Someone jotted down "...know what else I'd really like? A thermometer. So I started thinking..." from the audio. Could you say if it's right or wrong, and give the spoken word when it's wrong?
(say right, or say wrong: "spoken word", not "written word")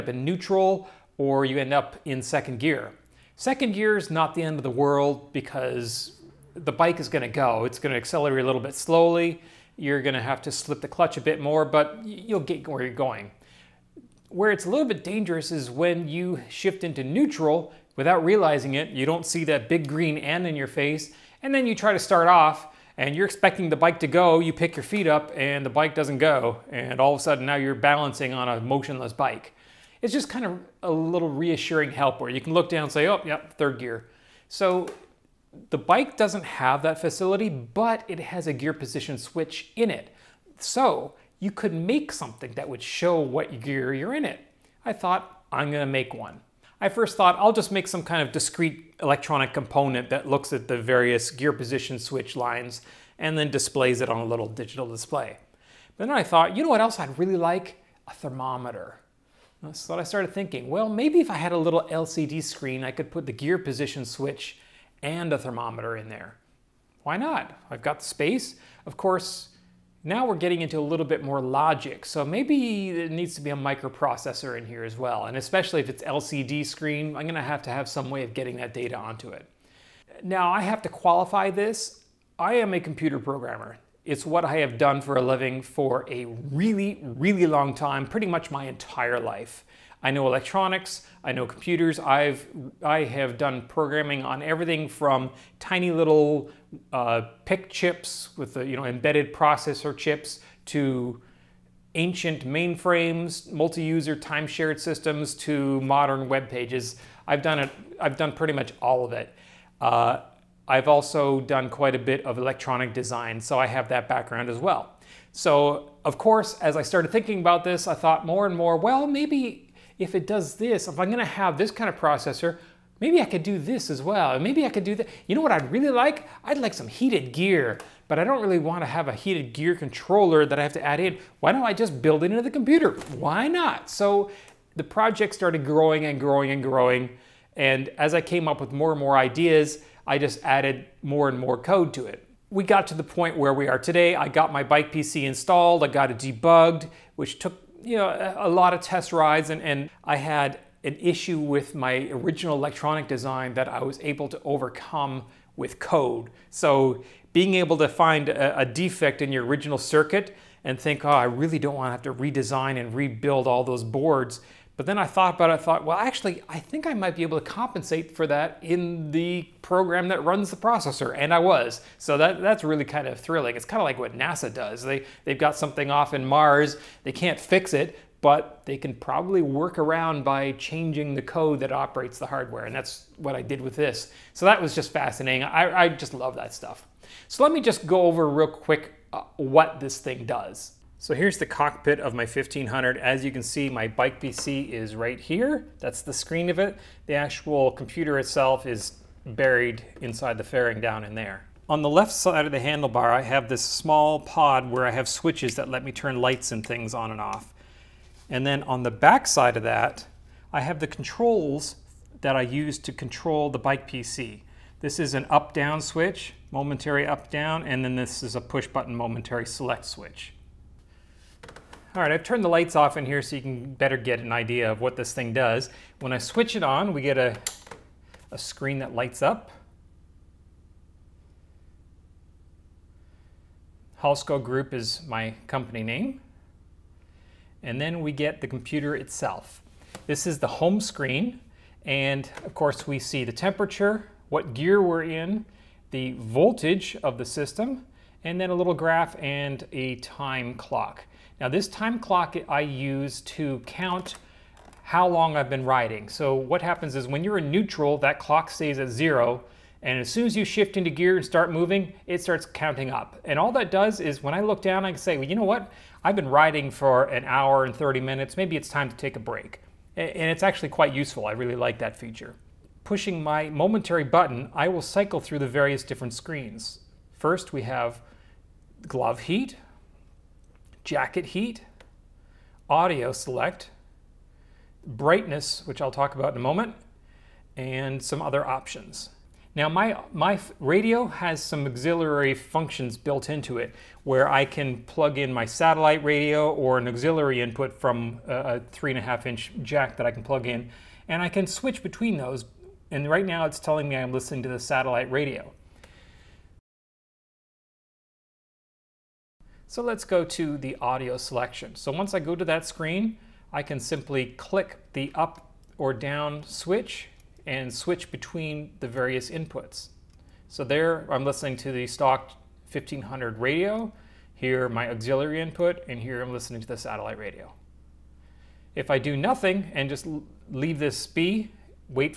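right.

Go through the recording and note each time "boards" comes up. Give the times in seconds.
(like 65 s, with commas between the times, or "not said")
163 s.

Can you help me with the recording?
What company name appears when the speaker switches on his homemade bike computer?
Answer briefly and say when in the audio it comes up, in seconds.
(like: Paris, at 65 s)
Halsko Group, at 234 s.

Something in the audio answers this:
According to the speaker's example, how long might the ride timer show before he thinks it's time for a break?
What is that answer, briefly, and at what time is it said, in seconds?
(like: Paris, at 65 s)
1 hour 30 minutes, at 267 s.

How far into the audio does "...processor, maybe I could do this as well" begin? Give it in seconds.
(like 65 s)
121 s.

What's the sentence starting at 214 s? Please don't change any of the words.
This is an up-down switch, momentary up-down, and then this is a push-button momentary select switch.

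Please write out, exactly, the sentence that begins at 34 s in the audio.
So the bike doesn't have that facility, but it has a gear position switch in it.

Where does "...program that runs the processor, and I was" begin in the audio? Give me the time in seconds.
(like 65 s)
169 s.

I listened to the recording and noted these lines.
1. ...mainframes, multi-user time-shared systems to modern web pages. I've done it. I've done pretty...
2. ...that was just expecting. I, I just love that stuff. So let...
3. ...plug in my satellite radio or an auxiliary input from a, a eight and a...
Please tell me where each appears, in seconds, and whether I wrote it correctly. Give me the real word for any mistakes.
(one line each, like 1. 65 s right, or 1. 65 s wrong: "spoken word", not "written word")
1. 102 s right
2. 184 s wrong: "fascinating", not "expecting"
3. 294 s wrong: "three", not "eight".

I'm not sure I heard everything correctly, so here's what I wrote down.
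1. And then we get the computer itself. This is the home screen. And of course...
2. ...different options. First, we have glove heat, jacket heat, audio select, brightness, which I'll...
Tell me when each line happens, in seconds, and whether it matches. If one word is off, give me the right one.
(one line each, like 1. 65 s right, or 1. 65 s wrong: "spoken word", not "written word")
1. 237 s right
2. 275 s wrong: "screens", not "options".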